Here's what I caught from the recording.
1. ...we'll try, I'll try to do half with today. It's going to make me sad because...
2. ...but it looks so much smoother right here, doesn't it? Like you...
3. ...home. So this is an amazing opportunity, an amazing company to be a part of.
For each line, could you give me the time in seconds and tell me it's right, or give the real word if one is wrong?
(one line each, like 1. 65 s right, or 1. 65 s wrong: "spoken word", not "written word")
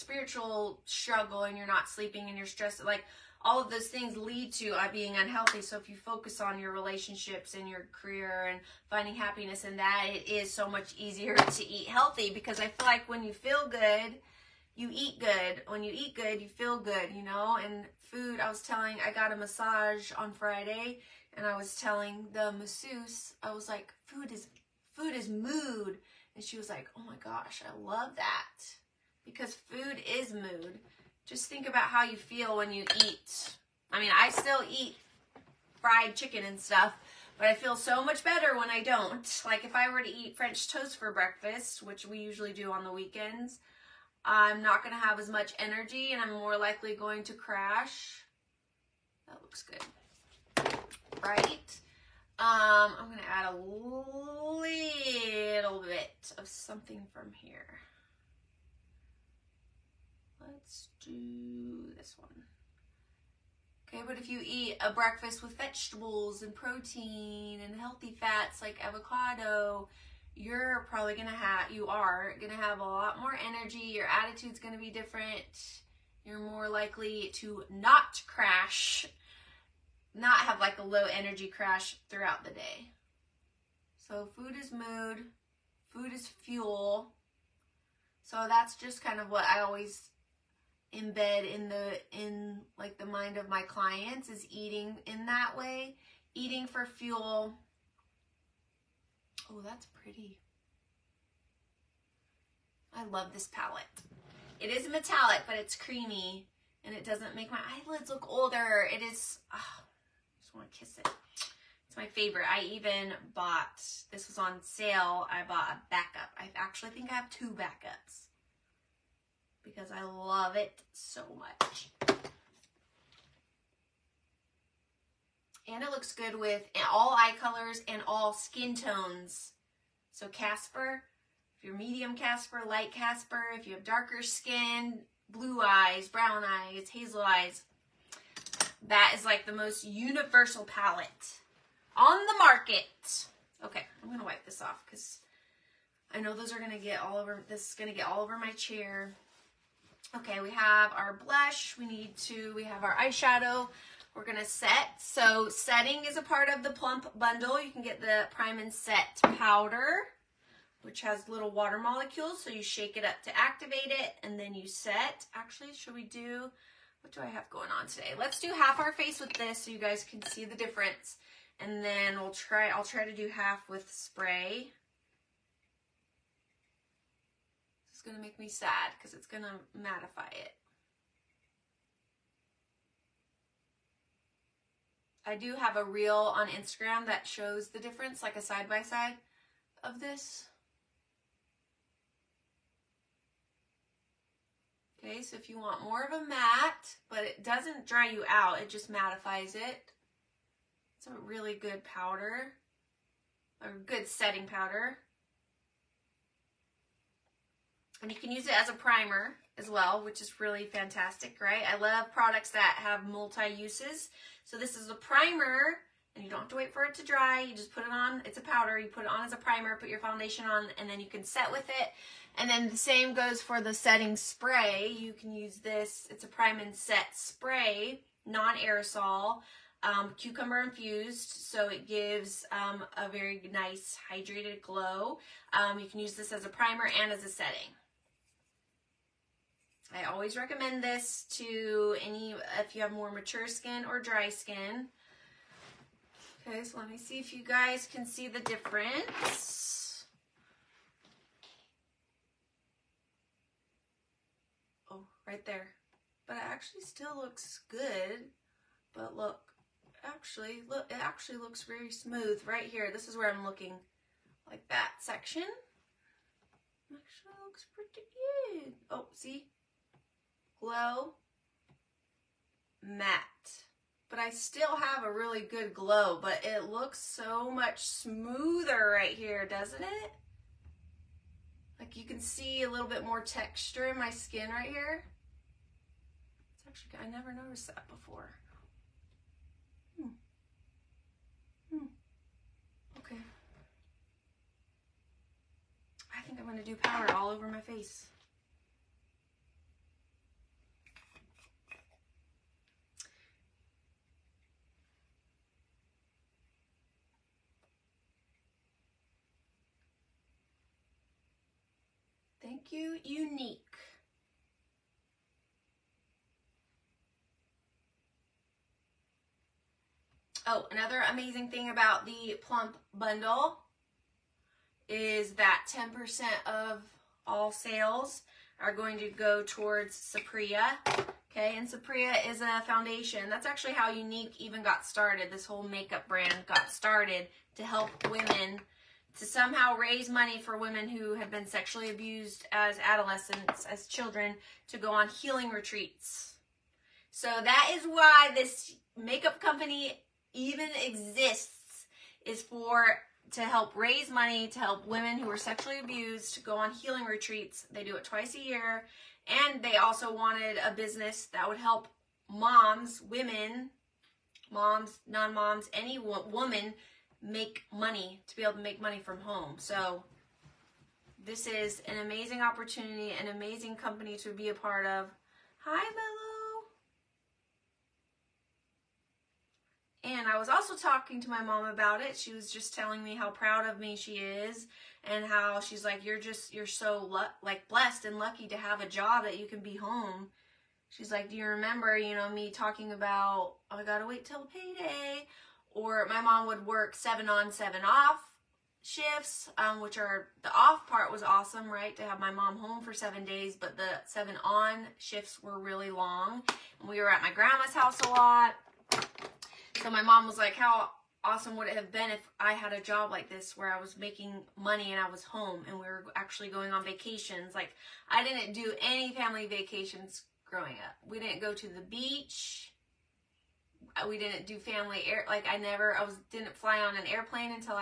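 1. 172 s wrong: "spray", not "today"
2. 276 s right
3. 369 s right.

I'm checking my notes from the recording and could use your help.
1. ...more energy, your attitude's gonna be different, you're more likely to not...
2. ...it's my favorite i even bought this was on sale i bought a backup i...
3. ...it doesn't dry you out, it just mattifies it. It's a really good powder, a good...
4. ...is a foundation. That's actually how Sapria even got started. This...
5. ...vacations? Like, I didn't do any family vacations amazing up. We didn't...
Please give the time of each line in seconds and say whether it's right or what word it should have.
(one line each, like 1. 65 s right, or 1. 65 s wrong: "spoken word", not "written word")
1. 73 s right
2. 111 s right
3. 197 s right
4. 332 s wrong: "Younique", not "Sapria"
5. 416 s wrong: "growing", not "amazing".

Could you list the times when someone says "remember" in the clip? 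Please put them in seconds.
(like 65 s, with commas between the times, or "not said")
391 s.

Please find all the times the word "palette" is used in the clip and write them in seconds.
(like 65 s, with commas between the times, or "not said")
103 s, 140 s.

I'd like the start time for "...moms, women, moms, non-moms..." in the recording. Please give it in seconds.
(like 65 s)
362 s.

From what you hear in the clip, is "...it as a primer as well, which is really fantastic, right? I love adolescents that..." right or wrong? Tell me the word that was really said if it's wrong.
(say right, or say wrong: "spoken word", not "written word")
wrong: "products", not "adolescents".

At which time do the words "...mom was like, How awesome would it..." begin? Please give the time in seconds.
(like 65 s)
410 s.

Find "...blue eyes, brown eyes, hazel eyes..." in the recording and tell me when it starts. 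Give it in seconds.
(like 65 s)
135 s.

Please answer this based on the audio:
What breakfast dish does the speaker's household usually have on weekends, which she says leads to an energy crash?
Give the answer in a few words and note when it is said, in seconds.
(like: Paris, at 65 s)
French toast, at 40 s.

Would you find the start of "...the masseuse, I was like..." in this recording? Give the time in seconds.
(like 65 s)
22 s.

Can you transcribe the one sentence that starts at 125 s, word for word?
And it looks good with all eye colors and all skin tones.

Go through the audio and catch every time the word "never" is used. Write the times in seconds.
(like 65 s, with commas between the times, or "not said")
287 s, 425 s.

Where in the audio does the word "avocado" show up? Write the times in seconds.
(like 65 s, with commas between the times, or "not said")
68 s.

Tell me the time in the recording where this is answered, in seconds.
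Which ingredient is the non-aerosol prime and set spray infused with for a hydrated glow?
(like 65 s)
230 s.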